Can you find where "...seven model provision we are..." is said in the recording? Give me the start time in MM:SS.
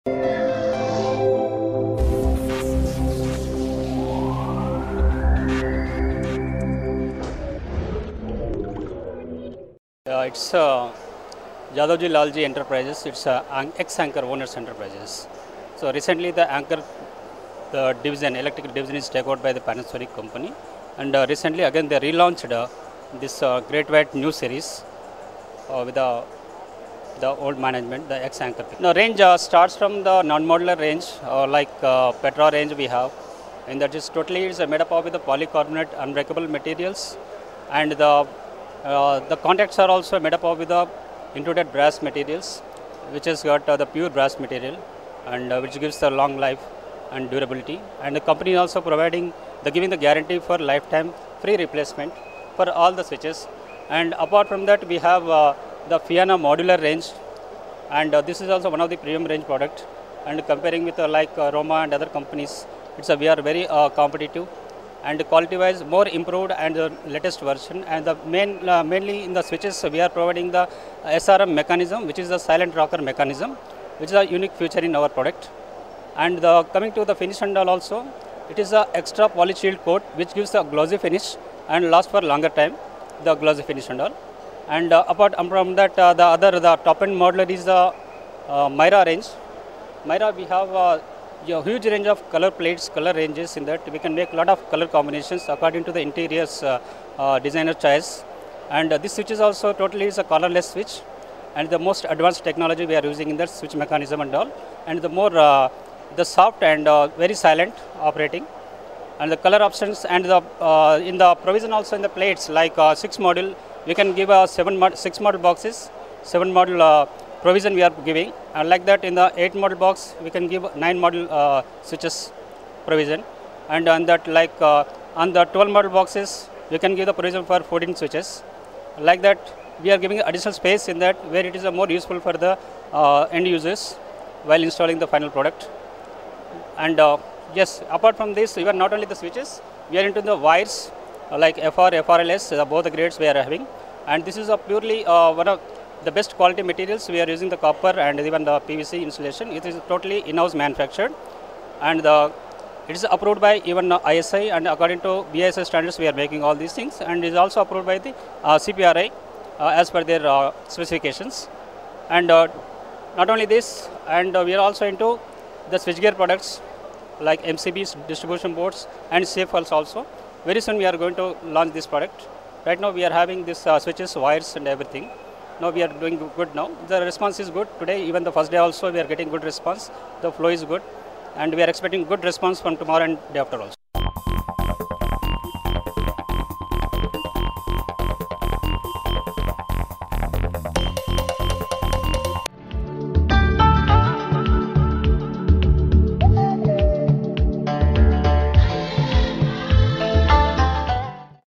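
01:56.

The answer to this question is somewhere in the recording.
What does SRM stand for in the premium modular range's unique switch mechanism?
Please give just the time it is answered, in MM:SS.
01:12.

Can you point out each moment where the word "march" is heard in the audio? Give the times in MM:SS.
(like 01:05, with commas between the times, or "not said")
not said.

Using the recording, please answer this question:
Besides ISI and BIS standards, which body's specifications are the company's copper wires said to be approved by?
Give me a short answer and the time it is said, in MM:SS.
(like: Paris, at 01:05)
CPRI, at 02:38.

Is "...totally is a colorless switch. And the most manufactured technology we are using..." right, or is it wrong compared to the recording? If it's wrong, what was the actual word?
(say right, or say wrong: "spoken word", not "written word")
wrong: "advanced", not "manufactured".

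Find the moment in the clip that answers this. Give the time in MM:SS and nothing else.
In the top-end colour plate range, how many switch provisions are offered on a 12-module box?
02:07.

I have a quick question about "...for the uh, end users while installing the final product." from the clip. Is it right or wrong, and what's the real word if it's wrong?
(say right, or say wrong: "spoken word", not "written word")
right.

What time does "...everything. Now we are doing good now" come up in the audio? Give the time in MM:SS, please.
02:54.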